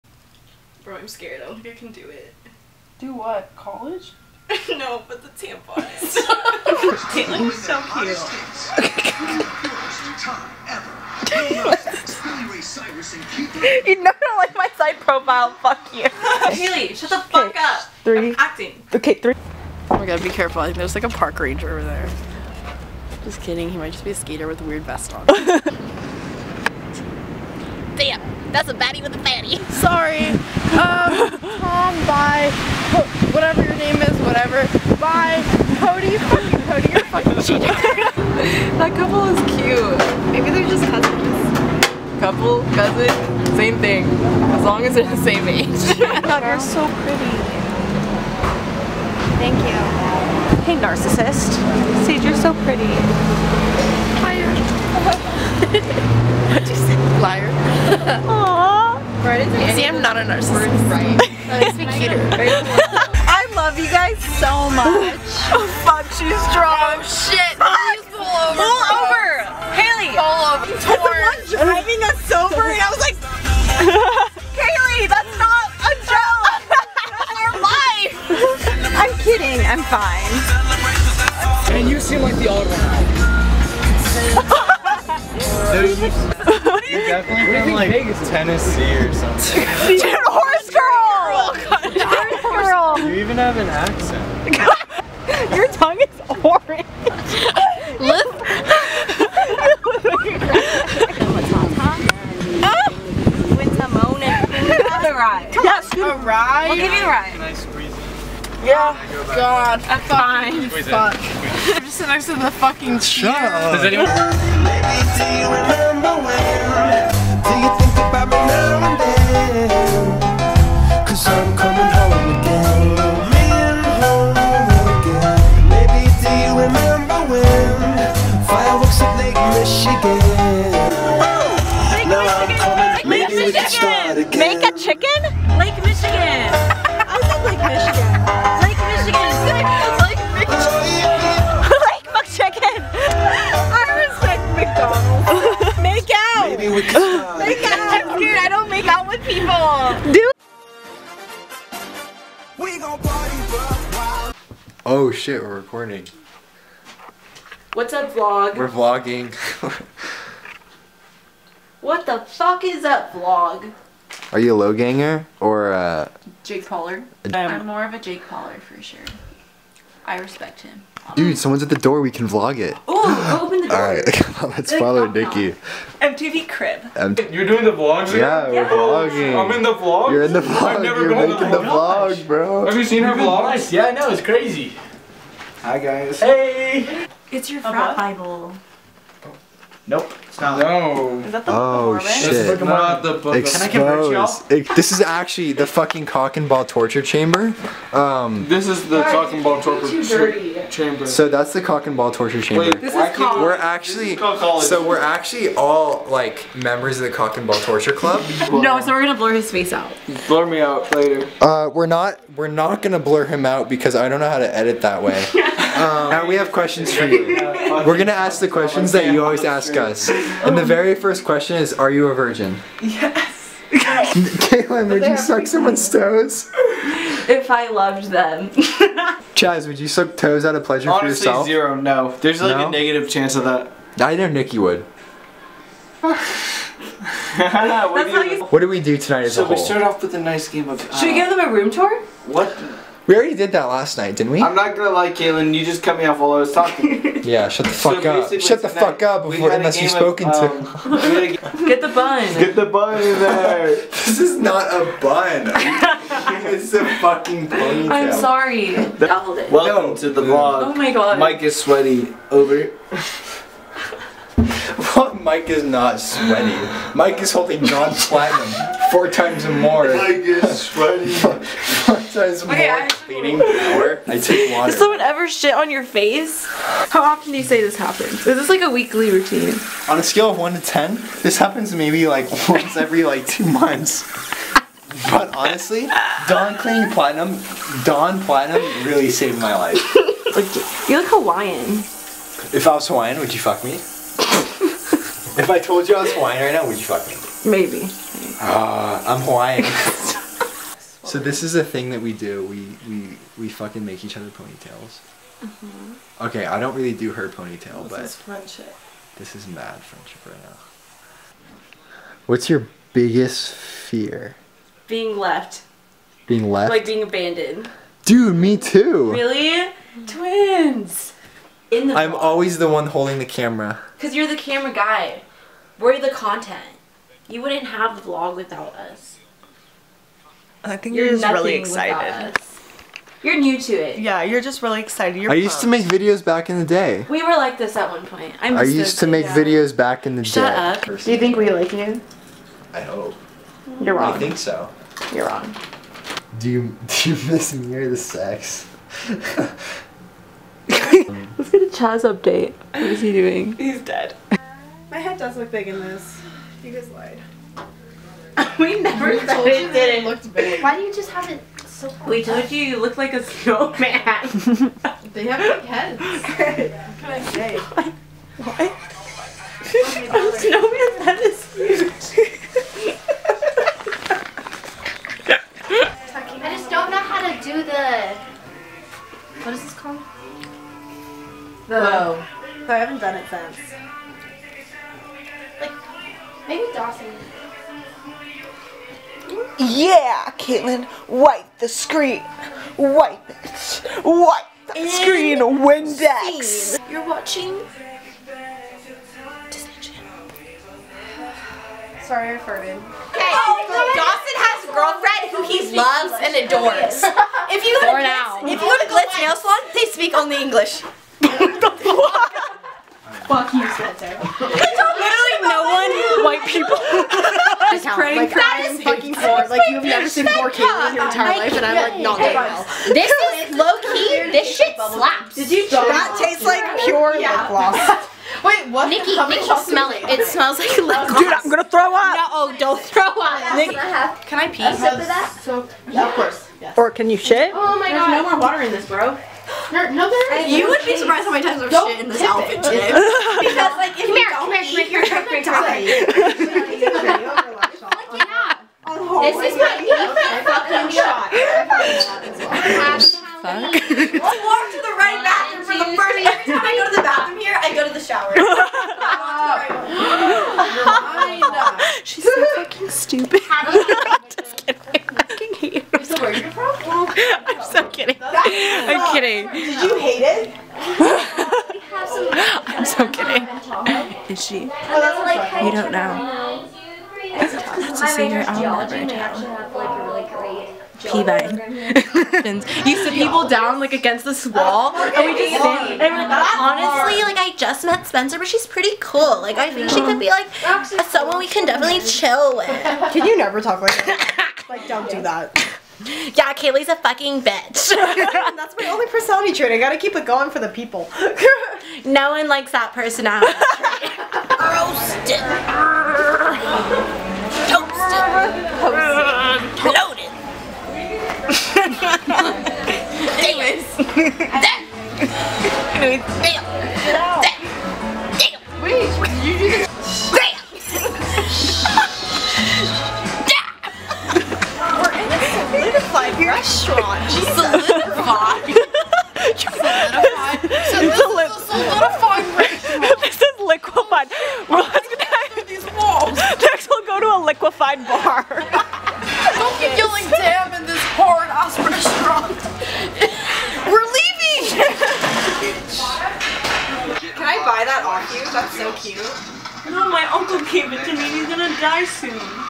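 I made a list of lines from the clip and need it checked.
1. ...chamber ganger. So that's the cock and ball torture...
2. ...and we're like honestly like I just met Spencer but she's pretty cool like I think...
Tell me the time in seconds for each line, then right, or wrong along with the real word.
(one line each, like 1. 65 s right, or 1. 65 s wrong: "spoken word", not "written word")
1. 200 s wrong: "chamber", not "ganger"
2. 485 s right.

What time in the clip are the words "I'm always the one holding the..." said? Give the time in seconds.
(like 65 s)
321 s.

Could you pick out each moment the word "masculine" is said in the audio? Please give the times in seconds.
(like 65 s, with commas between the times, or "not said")
not said.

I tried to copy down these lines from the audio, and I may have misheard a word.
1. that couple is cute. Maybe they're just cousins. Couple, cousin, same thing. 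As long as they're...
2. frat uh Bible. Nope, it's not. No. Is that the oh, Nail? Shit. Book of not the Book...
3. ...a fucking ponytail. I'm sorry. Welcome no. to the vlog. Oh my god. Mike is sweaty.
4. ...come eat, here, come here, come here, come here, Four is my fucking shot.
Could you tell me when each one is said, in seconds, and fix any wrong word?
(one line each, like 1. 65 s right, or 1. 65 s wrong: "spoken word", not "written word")
1. 37 s right
2. 187 s wrong: "Mormon", not "Nail"
3. 256 s right
4. 444 s wrong: "This", not "Four".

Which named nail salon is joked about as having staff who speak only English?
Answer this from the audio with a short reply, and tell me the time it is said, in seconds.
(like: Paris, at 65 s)
Glitz Nail Salon, at 408 s.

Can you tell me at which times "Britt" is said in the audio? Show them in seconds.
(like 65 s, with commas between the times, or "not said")
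not said.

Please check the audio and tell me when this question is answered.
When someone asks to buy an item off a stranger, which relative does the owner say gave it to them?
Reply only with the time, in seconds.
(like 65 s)
550 s.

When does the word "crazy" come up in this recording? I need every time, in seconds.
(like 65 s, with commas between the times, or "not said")
184 s.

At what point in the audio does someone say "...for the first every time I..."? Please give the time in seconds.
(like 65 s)
455 s.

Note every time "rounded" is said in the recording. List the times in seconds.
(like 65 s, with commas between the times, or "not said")
not said.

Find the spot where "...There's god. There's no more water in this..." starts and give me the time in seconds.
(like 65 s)
437 s.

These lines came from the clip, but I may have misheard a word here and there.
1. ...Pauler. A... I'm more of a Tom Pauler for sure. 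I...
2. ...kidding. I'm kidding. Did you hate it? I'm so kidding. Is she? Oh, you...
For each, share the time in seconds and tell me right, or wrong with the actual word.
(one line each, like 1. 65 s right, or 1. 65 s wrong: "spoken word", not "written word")
1. 166 s wrong: "Jake", not "Tom"
2. 467 s right.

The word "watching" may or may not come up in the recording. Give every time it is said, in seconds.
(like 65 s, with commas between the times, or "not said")
397 s.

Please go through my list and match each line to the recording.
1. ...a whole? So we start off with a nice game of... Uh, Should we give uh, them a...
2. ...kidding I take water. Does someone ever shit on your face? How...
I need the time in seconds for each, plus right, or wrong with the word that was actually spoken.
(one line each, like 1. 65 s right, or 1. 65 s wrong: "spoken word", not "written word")
1. 239 s right
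2. 272 s wrong: "cleaning", not "kidding".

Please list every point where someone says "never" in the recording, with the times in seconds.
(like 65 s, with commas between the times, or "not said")
180 s, 358 s, 419 s, 478 s, 493 s.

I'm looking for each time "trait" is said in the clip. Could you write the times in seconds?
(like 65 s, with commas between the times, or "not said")
499 s, 503 s.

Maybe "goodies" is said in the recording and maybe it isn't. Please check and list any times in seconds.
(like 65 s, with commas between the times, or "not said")
not said.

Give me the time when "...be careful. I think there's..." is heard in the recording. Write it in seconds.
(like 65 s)
20 s.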